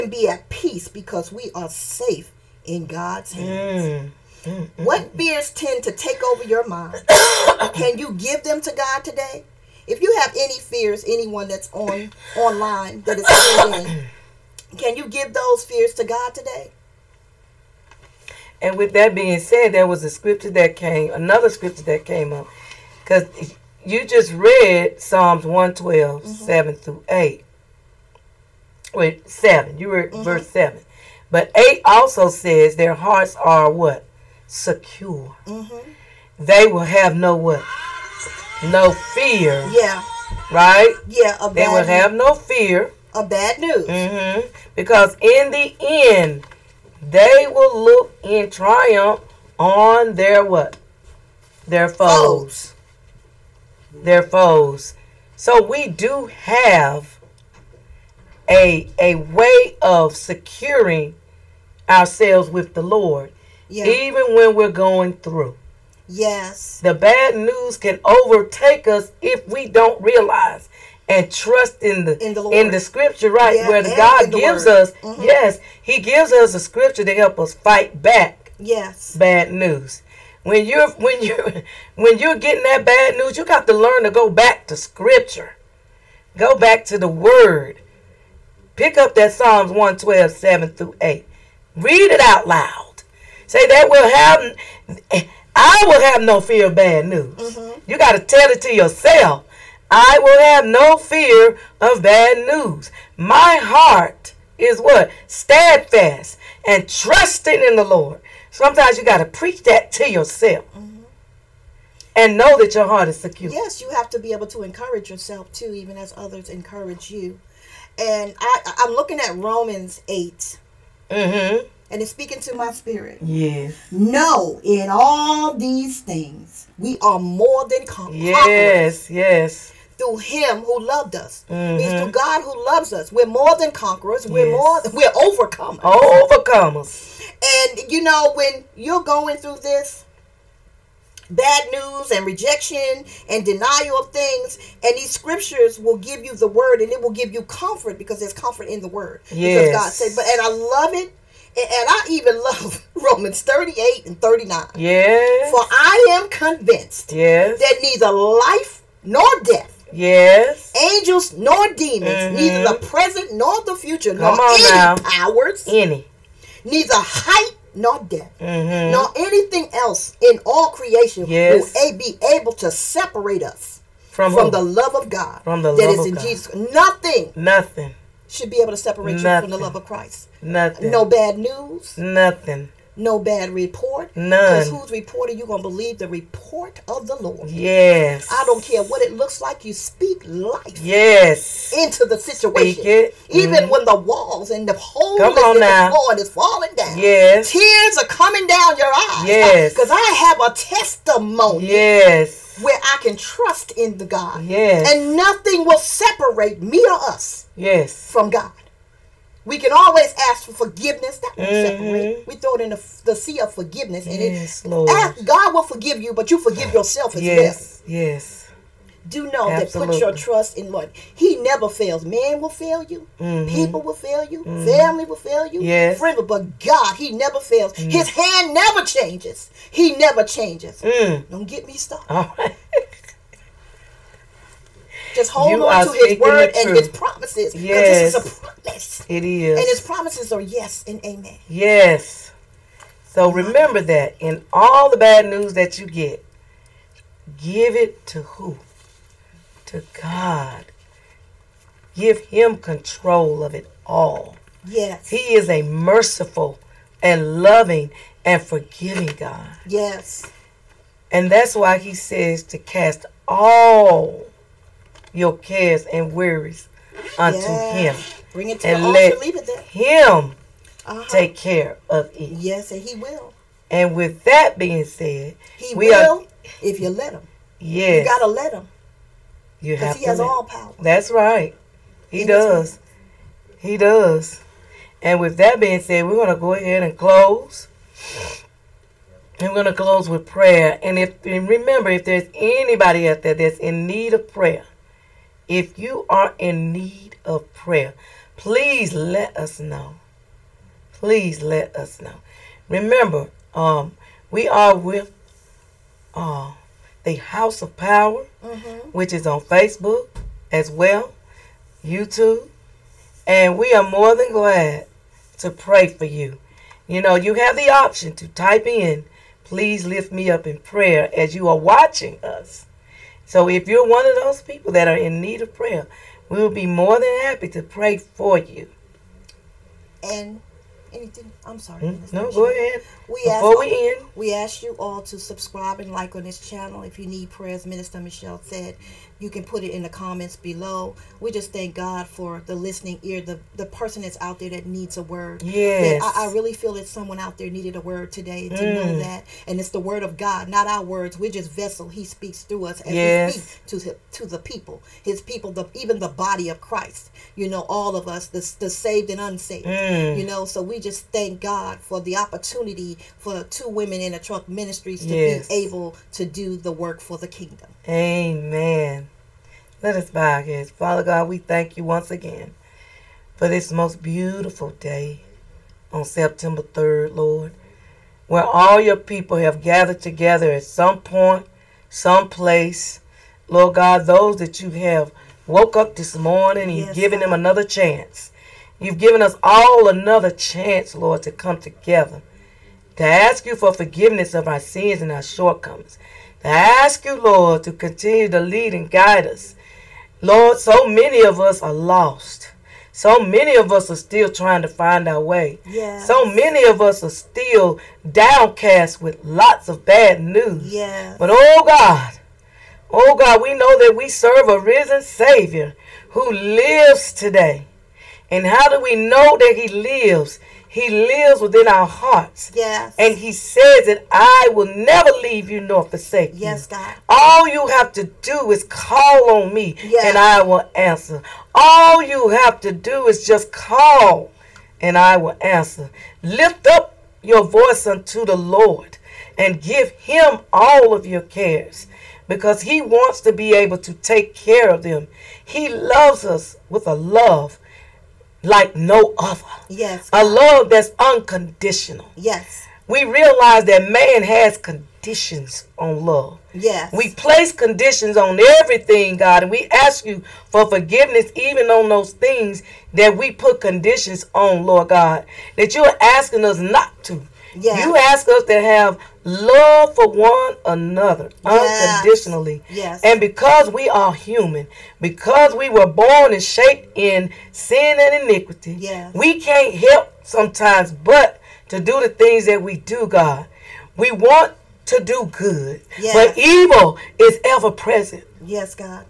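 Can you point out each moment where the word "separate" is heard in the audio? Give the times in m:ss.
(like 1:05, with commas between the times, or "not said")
2:52, 2:58, 3:25, 3:31.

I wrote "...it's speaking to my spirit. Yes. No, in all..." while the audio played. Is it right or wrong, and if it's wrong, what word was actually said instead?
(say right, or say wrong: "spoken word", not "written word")
right.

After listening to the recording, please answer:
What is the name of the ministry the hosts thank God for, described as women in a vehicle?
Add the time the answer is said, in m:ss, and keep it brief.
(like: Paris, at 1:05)
Two Women in a Truck, at 6:03.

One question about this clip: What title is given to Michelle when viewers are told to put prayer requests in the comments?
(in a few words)
Minister.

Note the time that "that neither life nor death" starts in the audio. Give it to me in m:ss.
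2:37.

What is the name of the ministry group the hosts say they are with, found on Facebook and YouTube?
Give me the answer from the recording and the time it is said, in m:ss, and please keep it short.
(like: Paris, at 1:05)
House of Power, at 5:07.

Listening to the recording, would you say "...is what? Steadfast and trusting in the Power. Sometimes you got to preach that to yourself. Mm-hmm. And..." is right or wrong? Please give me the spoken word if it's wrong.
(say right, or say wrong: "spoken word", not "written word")
wrong: "Lord", not "Power".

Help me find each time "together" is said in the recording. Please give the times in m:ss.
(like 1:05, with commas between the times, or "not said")
6:20, 6:31.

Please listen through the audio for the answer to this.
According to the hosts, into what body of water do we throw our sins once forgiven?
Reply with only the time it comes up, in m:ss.
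3:33.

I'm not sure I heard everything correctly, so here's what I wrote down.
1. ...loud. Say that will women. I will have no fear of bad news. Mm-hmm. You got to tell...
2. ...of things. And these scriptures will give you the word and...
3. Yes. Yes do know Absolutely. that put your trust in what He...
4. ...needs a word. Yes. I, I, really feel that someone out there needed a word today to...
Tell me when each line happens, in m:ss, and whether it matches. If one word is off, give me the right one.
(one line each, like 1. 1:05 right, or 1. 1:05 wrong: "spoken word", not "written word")
1. 1:32 wrong: "happen", not "women"
2. 2:23 right
3. 3:37 right
4. 5:44 right.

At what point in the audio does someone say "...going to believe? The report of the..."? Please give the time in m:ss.
3:05.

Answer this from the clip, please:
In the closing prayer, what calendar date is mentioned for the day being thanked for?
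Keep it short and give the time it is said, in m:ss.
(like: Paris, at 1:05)
September 3rd, at 6:16.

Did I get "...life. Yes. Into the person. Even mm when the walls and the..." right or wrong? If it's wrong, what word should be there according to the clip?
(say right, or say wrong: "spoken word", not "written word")
wrong: "situation", not "person".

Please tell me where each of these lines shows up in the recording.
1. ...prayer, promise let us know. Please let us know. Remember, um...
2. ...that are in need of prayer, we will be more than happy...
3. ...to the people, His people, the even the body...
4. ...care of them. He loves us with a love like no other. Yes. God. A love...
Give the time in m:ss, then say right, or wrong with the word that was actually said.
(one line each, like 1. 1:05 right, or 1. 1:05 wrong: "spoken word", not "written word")
1. 4:57 wrong: "please", not "promise"
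2. 5:24 right
3. 5:54 right
4. 7:24 right.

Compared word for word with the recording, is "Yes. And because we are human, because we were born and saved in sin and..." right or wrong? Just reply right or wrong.
wrong.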